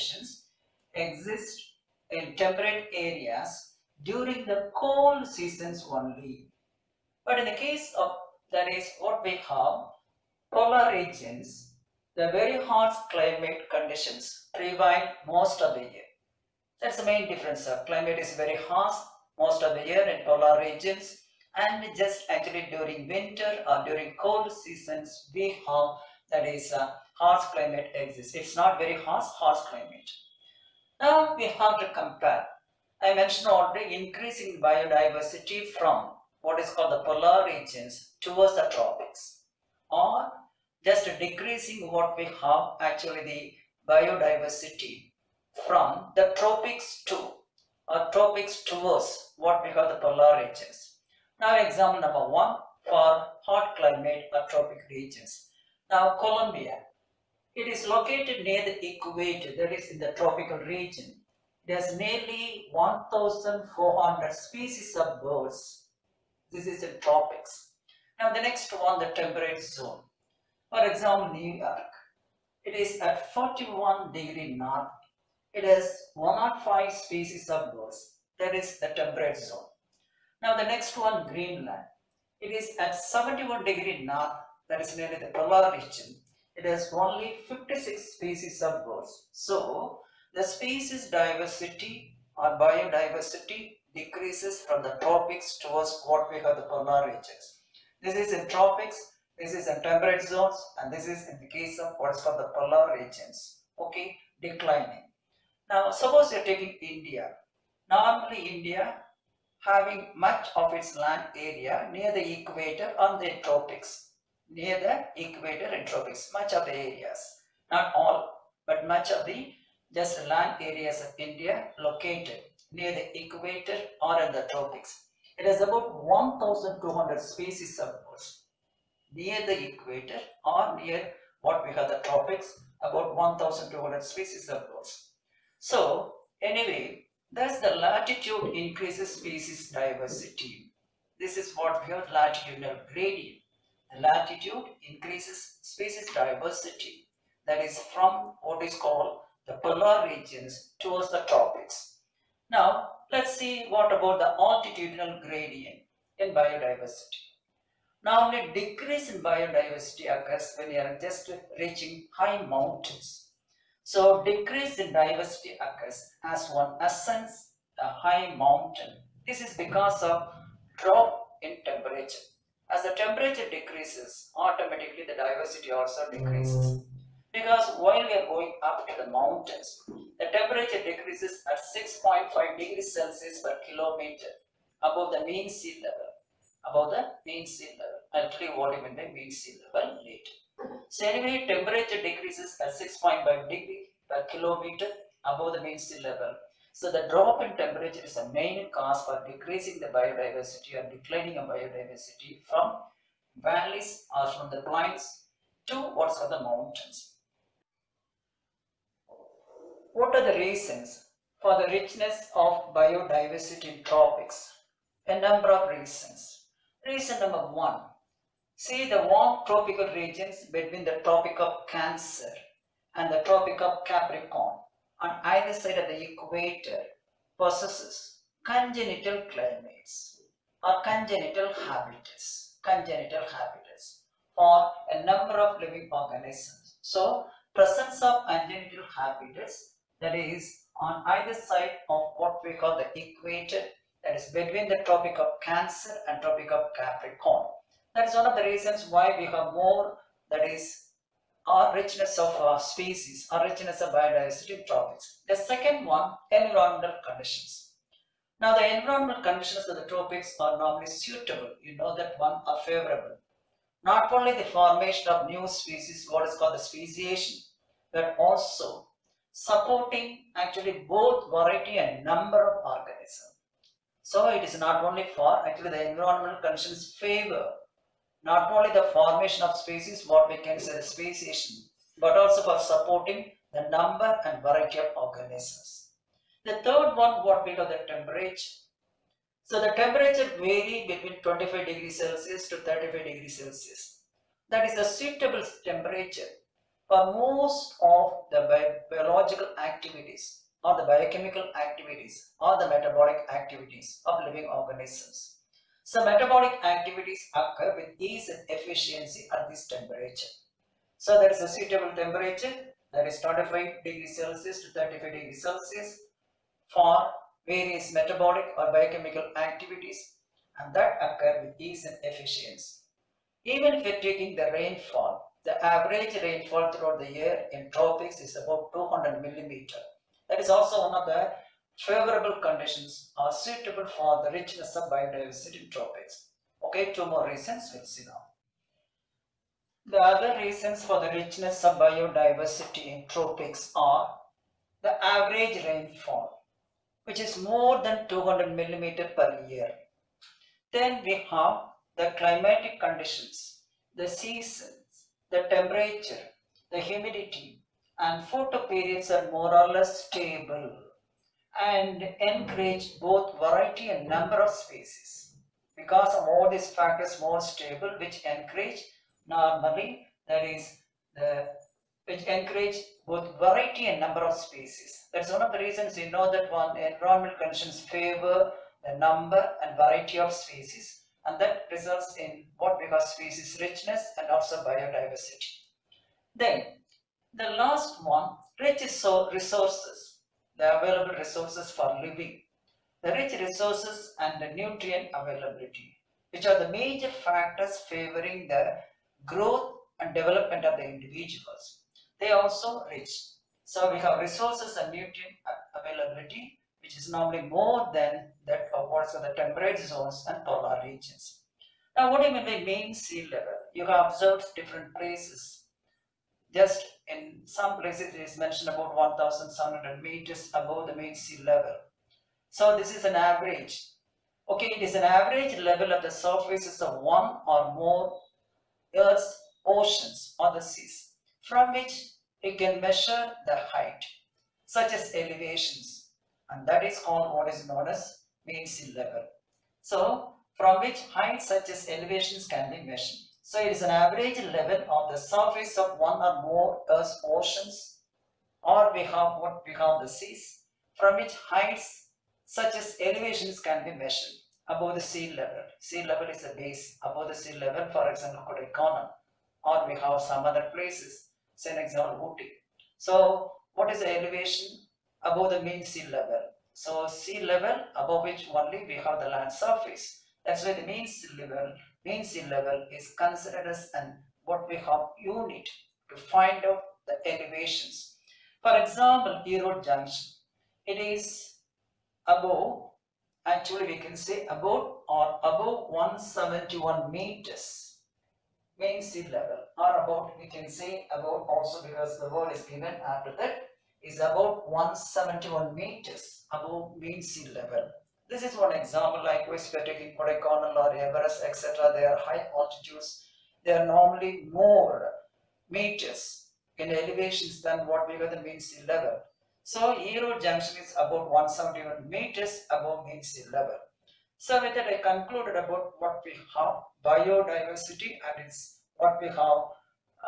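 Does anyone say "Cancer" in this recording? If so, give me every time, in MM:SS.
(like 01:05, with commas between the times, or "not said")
03:41, 04:05.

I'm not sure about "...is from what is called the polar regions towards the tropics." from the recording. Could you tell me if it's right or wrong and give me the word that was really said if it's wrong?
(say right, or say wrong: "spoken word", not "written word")
right.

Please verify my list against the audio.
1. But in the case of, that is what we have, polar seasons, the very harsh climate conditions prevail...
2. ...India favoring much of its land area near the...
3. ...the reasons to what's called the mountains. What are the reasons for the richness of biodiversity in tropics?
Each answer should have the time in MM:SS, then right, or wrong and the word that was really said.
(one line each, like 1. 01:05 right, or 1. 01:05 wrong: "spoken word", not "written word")
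1. 00:07 wrong: "regions", not "seasons"
2. 01:48 wrong: "having", not "favoring"
3. 03:24 wrong: "plains", not "reasons".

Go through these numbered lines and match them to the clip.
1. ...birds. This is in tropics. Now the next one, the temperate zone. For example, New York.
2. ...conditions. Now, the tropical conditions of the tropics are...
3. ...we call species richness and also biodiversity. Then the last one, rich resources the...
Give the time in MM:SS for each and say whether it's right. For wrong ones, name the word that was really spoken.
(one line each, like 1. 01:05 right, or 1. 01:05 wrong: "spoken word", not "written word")
1. 01:05 right
2. 04:17 wrong: "environmental", not "tropical"
3. 06:22 right.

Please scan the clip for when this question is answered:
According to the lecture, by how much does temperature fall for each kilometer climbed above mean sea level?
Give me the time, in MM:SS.
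03:01.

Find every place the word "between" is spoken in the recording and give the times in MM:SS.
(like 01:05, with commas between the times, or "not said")
03:40, 04:04, 04:50.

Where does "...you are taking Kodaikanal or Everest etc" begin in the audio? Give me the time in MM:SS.
08:19.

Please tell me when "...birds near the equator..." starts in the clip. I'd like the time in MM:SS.
02:08.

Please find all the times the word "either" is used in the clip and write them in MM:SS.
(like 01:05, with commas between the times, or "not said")
03:45, 04:01.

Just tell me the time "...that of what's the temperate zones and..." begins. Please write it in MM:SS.
06:48.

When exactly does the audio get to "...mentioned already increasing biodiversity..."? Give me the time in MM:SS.
00:33.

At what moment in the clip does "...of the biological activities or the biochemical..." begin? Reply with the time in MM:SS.
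04:57.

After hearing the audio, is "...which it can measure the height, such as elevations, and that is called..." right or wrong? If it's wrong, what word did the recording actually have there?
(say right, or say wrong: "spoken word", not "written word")
right.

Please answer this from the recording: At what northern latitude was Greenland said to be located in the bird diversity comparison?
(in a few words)
71 degrees north.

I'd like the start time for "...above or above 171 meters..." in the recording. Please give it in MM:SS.
08:04.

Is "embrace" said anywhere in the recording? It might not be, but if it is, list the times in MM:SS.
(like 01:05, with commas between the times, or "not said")
not said.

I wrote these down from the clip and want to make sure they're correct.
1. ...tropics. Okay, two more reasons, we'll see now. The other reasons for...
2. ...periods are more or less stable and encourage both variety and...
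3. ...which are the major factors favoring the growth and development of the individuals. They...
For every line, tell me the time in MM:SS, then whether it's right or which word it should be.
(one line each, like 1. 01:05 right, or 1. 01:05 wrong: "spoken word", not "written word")
1. 05:35 right
2. 05:58 right
3. 06:36 right.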